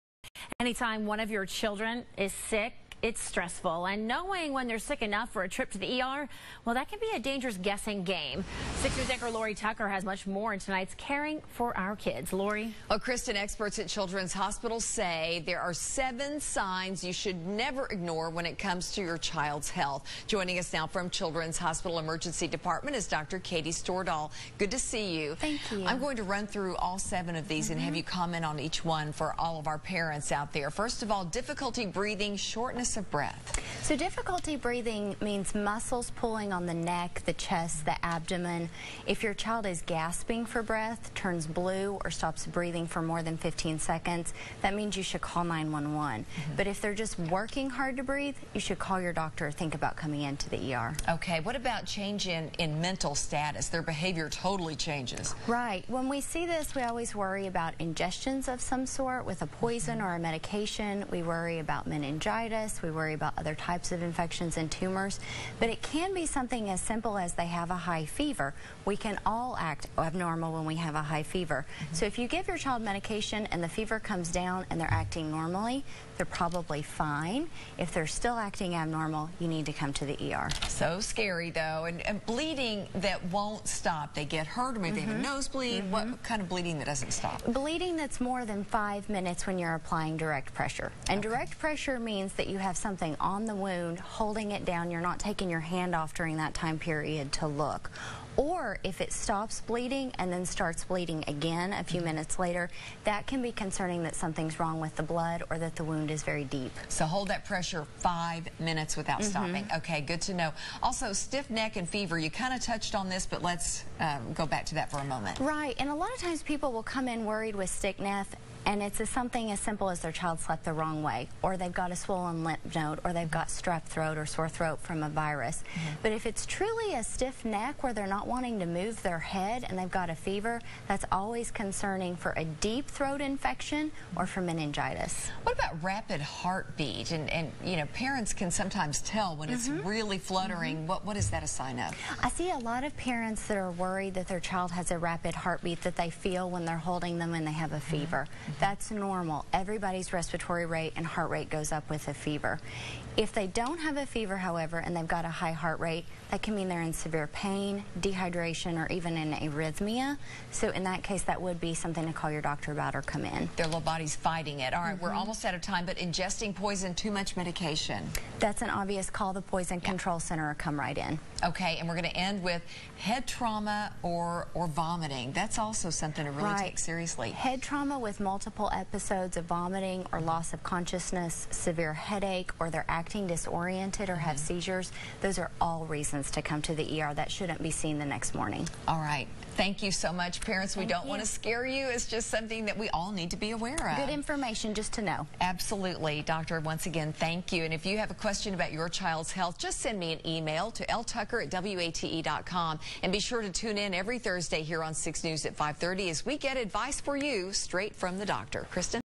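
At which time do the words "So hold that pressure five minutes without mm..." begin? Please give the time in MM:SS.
01:46.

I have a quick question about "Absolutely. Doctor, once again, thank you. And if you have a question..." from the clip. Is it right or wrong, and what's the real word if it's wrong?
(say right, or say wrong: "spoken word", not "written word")
right.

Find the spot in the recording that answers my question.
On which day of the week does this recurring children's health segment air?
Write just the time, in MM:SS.
03:24.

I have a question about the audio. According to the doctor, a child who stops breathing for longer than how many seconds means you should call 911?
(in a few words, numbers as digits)
15.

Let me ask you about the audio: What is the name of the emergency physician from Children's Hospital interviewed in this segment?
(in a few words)
Katie Stordahl.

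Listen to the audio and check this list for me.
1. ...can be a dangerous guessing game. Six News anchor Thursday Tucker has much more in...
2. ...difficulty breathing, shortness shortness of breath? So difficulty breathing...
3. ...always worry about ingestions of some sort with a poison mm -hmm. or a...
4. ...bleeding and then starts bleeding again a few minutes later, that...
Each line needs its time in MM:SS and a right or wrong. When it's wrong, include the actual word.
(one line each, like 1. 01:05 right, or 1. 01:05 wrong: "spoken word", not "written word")
1. 00:06 wrong: "Lori", not "Thursday"
2. 00:31 right
3. 00:56 right
4. 01:39 right.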